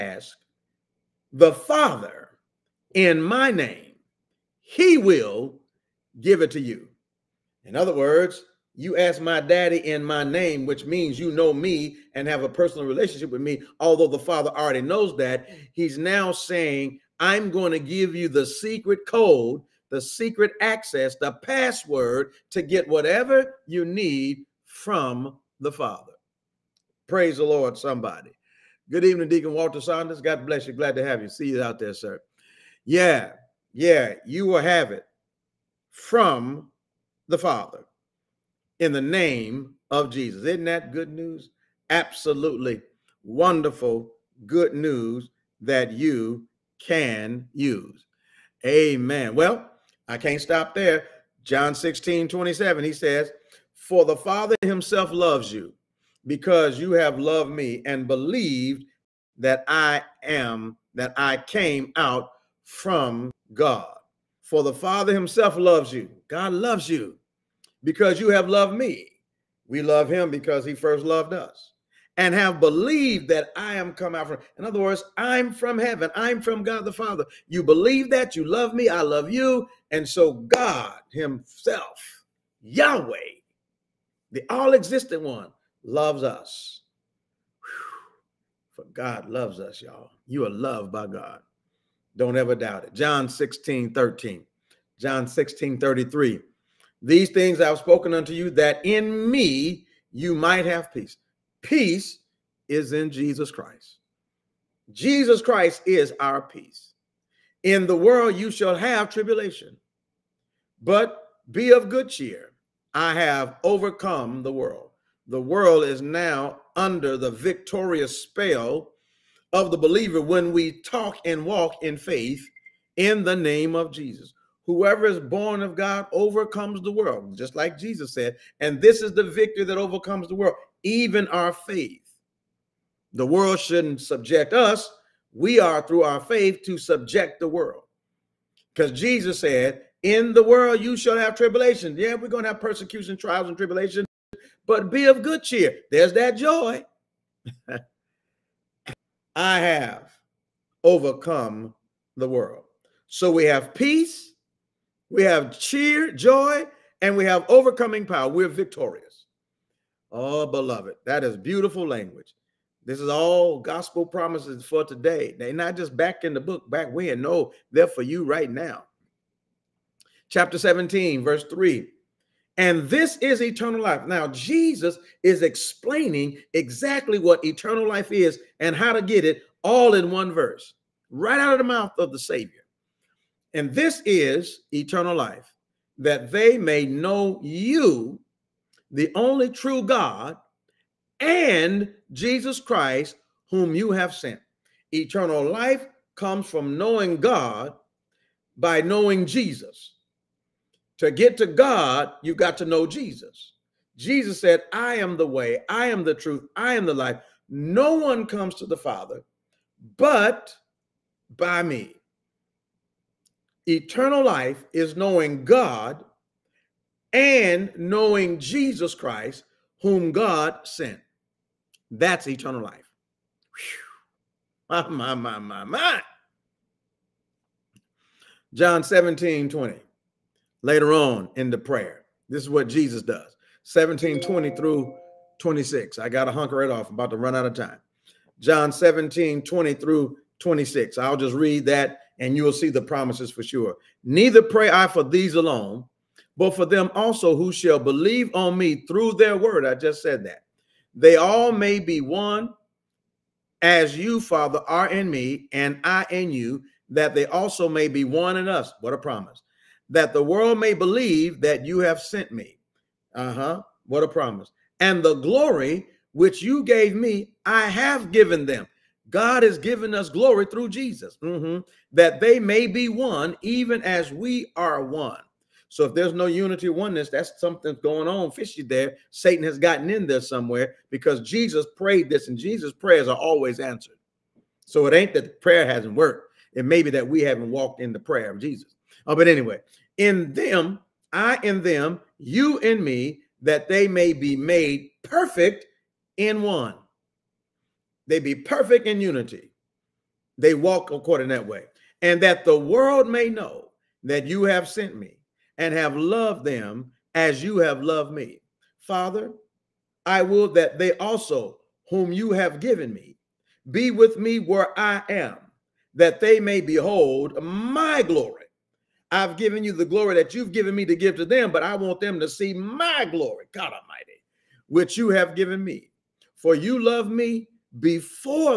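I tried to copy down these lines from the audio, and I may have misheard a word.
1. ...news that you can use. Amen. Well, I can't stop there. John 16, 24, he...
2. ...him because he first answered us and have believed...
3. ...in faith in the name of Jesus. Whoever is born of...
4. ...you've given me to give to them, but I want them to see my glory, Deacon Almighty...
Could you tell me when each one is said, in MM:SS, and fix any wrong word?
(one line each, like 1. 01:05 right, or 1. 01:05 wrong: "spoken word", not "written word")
1. 00:44 wrong: "27", not "24"
2. 01:10 wrong: "loved", not "answered"
3. 02:01 right
4. 05:20 wrong: "God", not "Deacon".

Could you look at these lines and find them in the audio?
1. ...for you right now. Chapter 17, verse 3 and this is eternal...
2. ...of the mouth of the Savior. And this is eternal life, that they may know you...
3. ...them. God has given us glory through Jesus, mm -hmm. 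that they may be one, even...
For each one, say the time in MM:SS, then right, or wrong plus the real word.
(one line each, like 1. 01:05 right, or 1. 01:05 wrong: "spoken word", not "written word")
1. 02:47 right
2. 03:01 right
3. 04:28 right.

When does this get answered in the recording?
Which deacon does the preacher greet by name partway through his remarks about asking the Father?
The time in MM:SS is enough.
00:29.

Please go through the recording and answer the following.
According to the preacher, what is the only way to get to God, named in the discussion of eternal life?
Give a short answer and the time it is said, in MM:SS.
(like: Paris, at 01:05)
Know Jesus, at 03:22.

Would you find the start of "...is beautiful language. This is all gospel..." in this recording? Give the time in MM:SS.
02:41.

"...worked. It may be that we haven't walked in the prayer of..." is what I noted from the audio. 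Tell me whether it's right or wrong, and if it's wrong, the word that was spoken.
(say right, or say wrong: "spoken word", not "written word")
right.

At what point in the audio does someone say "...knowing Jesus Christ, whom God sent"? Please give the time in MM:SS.
03:37.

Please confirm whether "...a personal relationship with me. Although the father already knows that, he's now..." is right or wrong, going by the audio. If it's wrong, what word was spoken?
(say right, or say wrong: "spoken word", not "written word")
right.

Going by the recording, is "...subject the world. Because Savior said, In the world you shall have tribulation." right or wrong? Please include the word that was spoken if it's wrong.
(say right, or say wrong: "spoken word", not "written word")
wrong: "Jesus", not "Savior".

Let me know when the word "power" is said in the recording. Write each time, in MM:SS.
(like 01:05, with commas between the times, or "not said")
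02:38.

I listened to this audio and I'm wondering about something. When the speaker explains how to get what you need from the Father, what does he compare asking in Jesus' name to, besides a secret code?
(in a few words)
The password.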